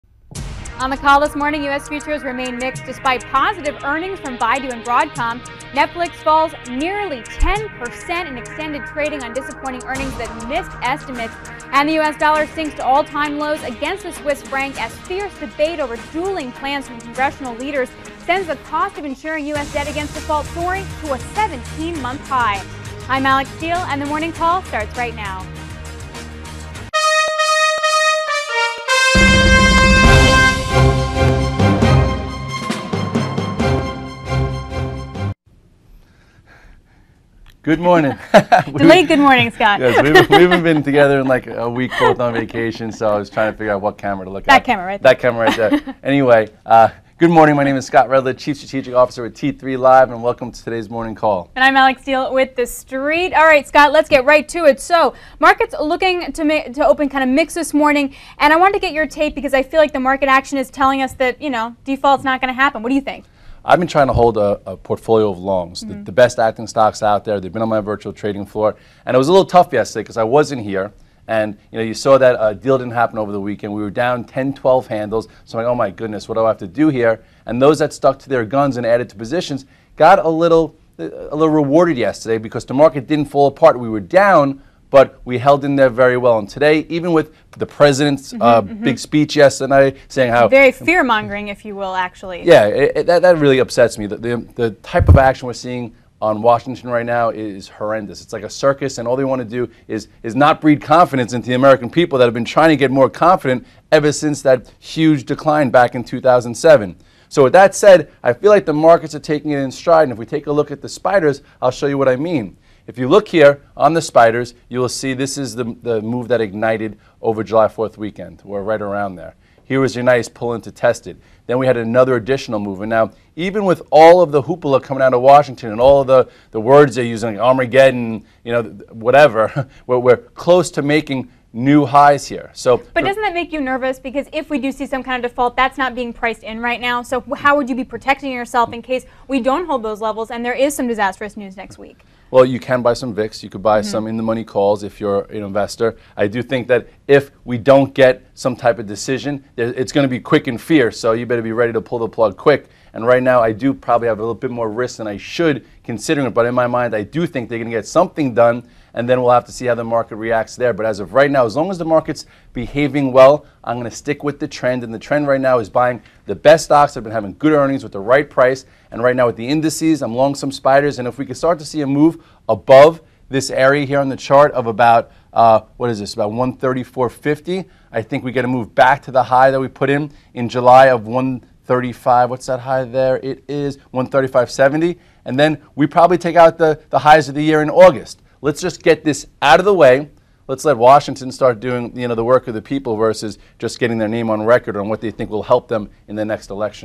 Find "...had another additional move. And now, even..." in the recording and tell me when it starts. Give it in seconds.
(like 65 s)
121 s.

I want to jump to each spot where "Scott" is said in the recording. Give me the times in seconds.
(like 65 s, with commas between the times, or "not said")
39 s, 47 s, 53 s.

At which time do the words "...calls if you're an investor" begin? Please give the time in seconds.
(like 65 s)
144 s.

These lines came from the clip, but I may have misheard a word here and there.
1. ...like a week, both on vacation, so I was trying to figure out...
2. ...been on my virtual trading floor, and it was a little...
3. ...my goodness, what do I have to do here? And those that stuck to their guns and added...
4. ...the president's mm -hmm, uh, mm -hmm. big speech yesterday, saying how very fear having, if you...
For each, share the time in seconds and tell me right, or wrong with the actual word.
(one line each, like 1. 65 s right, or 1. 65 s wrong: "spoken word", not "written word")
1. 41 s right
2. 67 s right
3. 75 s right
4. 87 s wrong: "mongering", not "having".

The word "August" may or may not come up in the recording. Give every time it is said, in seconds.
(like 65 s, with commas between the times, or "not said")
187 s.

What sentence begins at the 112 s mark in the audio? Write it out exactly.
If you look here on the spiders, you will see this is the, the move that ignited over July 4th weekend.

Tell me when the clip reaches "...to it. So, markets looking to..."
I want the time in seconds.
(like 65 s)
54 s.